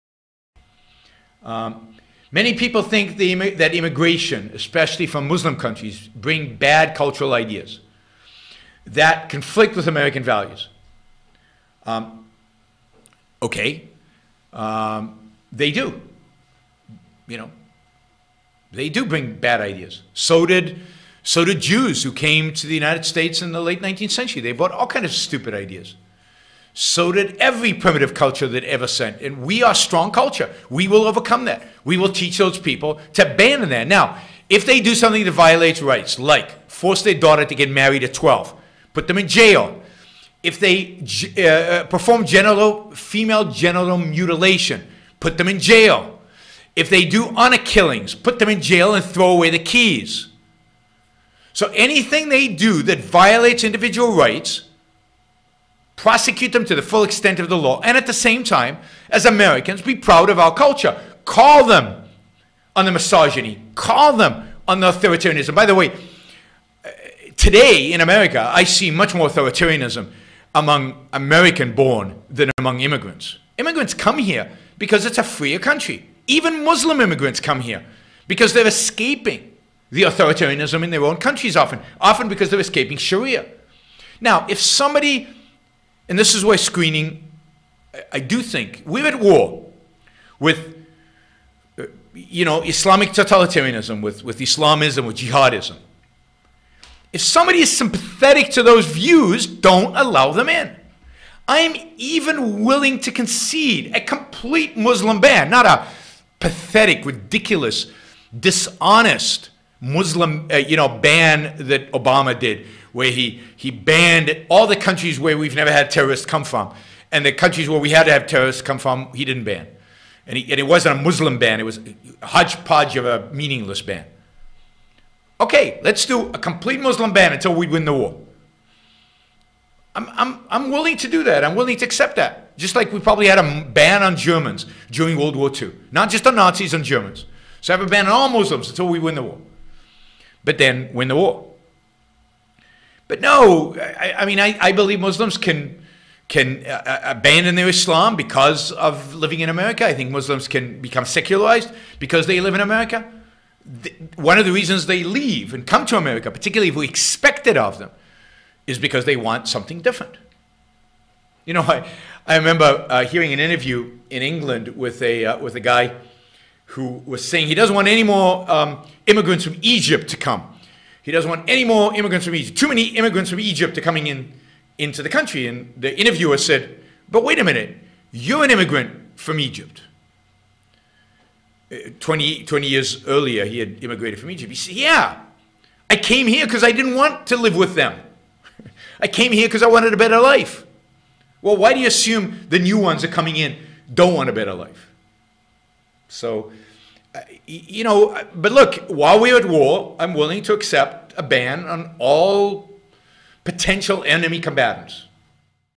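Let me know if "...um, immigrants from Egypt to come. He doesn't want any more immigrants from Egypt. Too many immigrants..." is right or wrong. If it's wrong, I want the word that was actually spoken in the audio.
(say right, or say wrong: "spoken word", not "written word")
right.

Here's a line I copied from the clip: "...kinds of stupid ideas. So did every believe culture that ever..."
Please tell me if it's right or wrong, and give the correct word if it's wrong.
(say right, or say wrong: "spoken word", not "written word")
wrong: "primitive", not "believe".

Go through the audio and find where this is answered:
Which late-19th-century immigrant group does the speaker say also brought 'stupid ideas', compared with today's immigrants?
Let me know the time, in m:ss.
0:21.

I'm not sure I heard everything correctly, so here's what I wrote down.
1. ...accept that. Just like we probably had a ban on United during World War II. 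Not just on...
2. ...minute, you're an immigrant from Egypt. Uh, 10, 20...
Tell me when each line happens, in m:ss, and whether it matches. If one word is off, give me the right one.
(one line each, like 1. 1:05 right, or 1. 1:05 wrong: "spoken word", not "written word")
1. 2:11 wrong: "Germans", not "United"
2. 2:57 wrong: "20", not "10".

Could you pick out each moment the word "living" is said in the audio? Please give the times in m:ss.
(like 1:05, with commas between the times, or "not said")
2:29.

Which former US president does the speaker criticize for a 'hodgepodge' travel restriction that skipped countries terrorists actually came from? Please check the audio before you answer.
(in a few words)
Obama.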